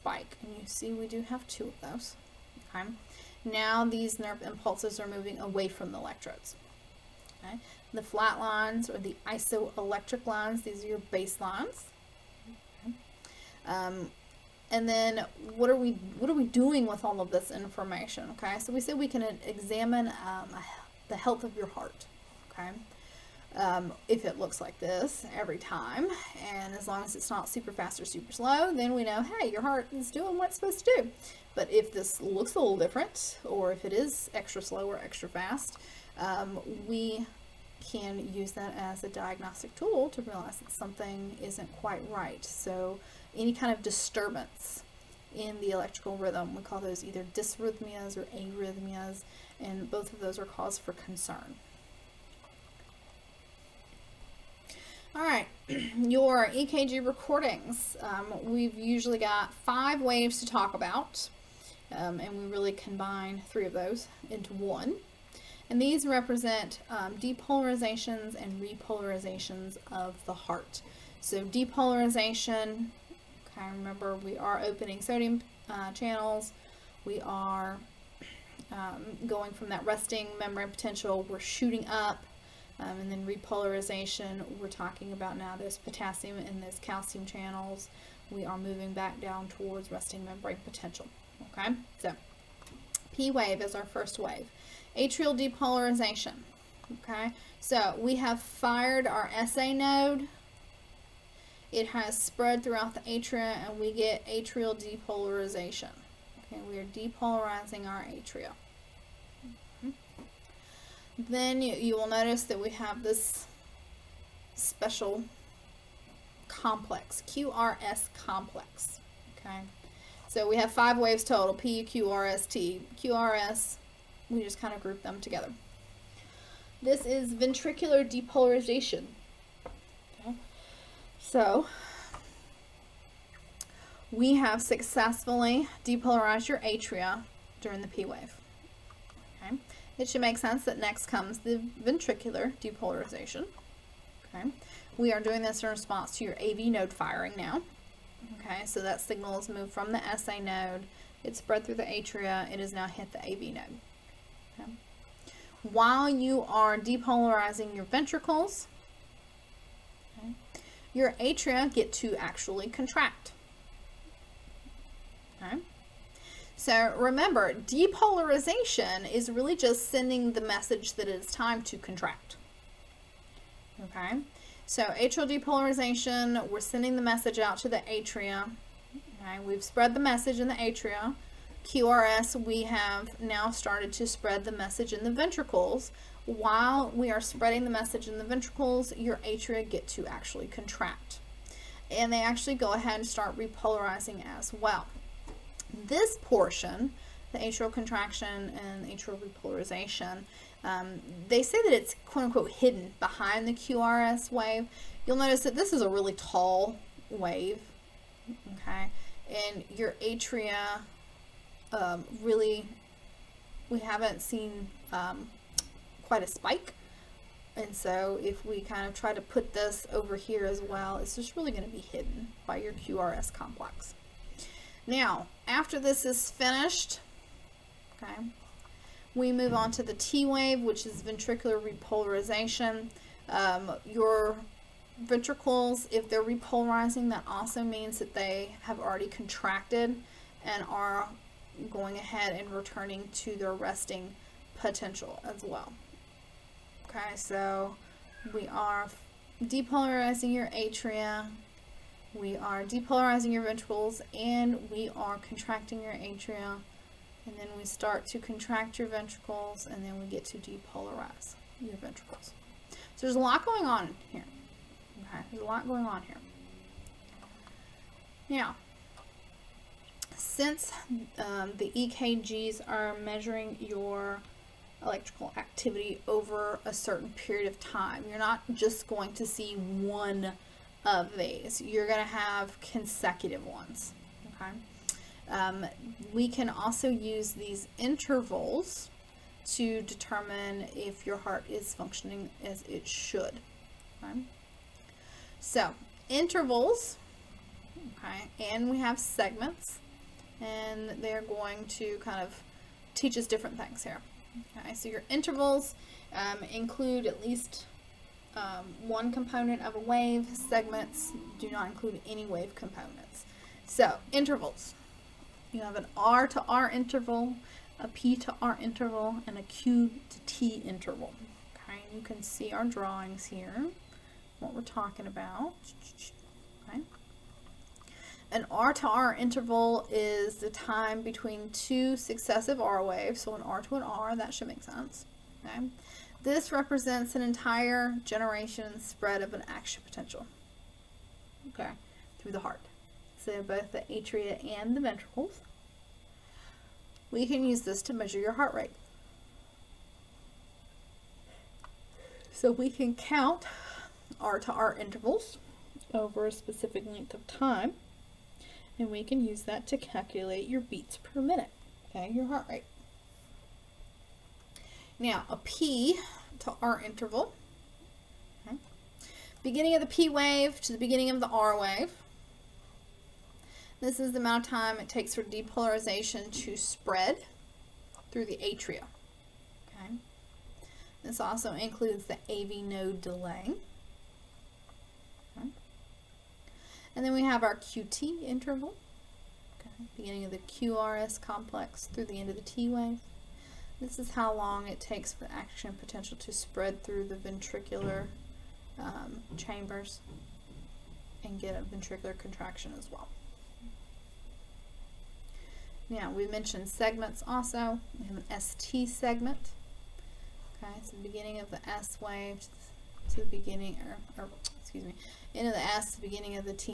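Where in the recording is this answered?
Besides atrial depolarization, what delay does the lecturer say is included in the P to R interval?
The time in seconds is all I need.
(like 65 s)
382 s.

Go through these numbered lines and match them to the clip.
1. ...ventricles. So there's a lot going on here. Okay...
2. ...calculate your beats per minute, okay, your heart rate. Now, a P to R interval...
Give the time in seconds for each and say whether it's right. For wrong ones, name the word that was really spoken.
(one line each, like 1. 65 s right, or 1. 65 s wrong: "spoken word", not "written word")
1. 261 s right
2. 359 s right.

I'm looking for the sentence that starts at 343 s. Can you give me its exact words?
So both the atria and the ventricles.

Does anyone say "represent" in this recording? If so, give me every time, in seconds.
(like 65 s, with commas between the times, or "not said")
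66 s, 336 s.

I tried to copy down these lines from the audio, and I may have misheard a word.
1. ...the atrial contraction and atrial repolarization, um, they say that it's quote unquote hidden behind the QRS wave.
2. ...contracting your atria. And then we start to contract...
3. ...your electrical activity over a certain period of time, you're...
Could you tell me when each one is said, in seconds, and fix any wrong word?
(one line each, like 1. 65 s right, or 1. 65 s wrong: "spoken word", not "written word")
1. 197 s right
2. 255 s right
3. 273 s right.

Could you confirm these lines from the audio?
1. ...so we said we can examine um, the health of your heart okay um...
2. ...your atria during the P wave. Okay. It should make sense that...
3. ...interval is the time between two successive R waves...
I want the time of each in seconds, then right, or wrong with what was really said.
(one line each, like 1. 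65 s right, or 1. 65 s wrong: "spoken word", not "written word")
1. 18 s right
2. 136 s right
3. 329 s right.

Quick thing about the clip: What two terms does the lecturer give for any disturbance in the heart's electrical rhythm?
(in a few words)
dysrhythmias or arrhythmias.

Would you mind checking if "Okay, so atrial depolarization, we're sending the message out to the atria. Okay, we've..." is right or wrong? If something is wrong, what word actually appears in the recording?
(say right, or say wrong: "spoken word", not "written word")
right.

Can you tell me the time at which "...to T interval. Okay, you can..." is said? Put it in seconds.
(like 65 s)
320 s.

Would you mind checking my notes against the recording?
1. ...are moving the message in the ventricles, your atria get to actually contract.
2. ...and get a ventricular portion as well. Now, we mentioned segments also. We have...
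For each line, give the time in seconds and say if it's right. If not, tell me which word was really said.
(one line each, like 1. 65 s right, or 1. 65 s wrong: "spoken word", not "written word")
1. 187 s wrong: "spreading", not "moving"
2. 401 s wrong: "contraction", not "portion".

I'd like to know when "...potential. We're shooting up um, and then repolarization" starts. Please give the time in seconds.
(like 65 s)
80 s.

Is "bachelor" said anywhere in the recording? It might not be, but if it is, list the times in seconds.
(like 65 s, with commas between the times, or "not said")
not said.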